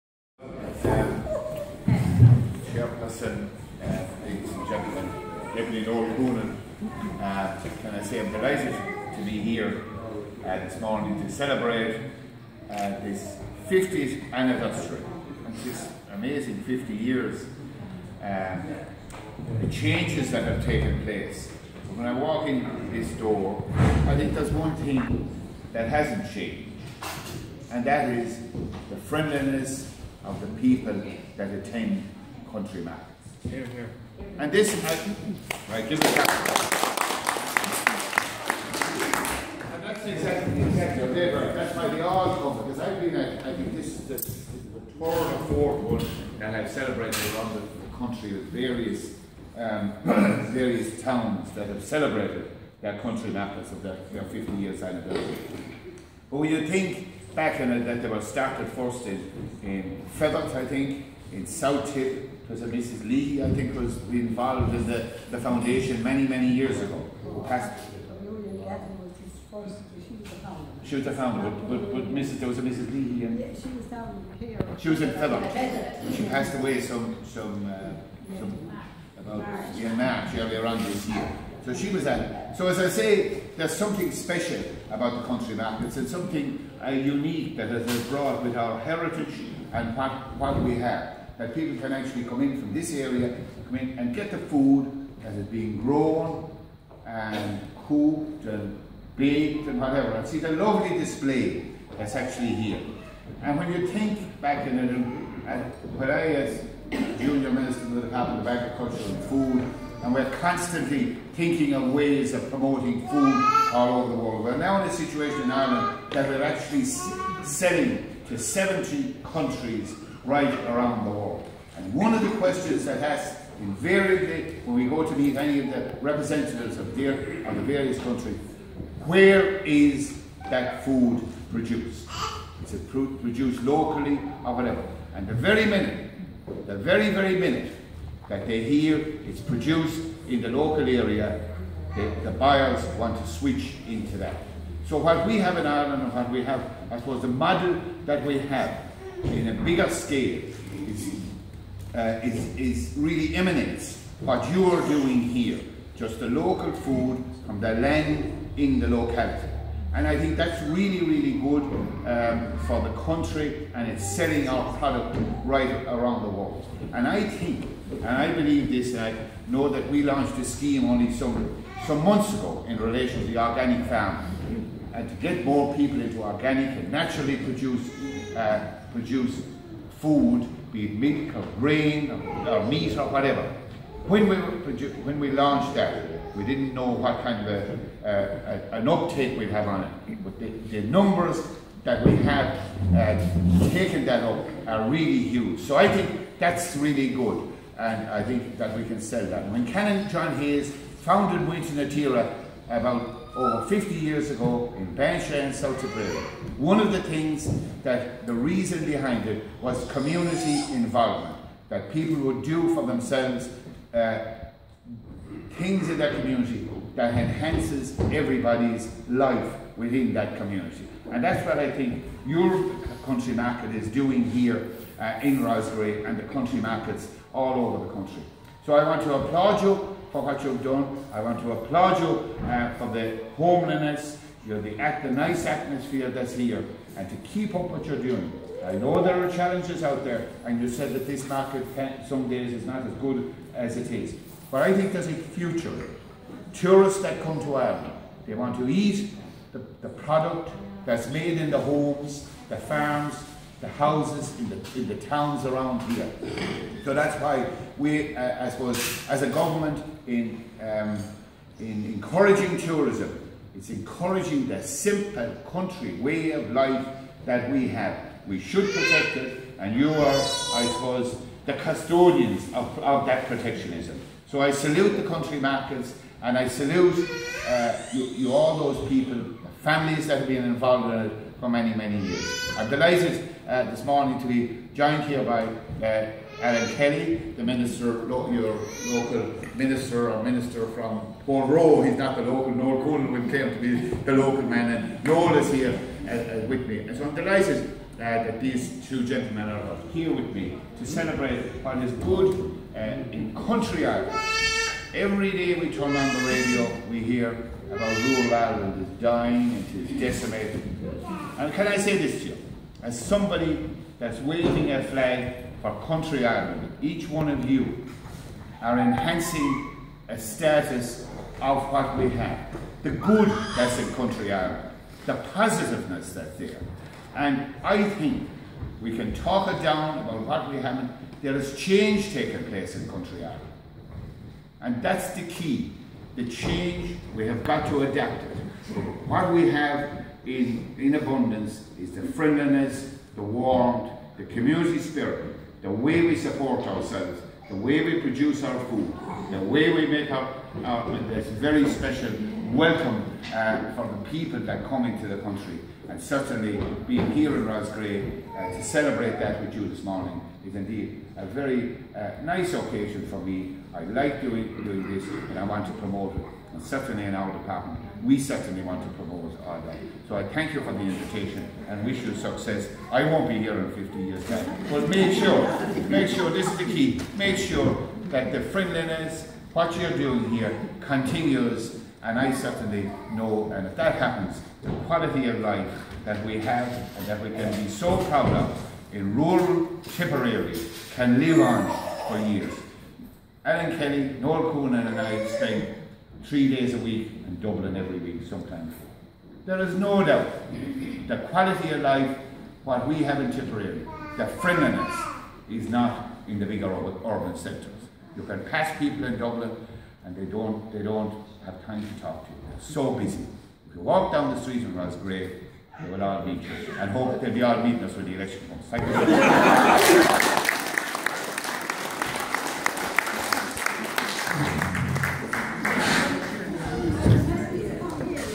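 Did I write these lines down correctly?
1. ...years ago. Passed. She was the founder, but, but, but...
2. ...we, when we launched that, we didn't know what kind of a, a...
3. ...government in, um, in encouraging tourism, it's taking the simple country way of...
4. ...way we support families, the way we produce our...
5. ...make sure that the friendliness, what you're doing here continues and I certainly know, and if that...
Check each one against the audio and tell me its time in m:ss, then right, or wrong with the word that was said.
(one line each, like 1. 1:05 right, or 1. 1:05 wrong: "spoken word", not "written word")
1. 1:06 right
2. 3:04 right
3. 4:19 wrong: "encouraging", not "taking"
4. 5:45 wrong: "ourselves", not "families"
5. 6:17 right.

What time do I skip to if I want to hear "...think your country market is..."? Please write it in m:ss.
3:41.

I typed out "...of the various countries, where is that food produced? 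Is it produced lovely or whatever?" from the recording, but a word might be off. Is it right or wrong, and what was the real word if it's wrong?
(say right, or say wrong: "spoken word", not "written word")
wrong: "locally", not "lovely".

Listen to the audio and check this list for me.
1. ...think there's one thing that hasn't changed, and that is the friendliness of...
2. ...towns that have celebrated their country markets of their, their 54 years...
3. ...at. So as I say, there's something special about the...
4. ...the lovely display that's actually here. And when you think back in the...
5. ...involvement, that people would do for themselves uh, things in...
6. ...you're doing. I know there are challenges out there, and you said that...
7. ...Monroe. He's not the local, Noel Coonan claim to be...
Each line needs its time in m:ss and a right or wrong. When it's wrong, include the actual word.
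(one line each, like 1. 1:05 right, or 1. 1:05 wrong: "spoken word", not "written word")
1. 0:24 right
2. 0:51 wrong: "50", not "54"
3. 1:22 right
4. 1:40 right
5. 3:30 right
6. 3:57 right
7. 4:51 right.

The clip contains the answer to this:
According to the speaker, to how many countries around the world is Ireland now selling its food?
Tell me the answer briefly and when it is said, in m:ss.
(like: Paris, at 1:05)
70, at 1:58.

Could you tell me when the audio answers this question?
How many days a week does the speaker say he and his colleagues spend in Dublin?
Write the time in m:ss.
6:36.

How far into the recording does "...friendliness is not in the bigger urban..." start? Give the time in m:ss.
6:44.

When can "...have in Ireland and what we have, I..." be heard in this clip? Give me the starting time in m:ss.
2:25.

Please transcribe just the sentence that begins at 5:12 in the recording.
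As somebody that's waving a flag for country Ireland, each one of you are enhancing a status of what we have.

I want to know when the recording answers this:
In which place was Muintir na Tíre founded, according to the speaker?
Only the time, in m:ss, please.
3:24.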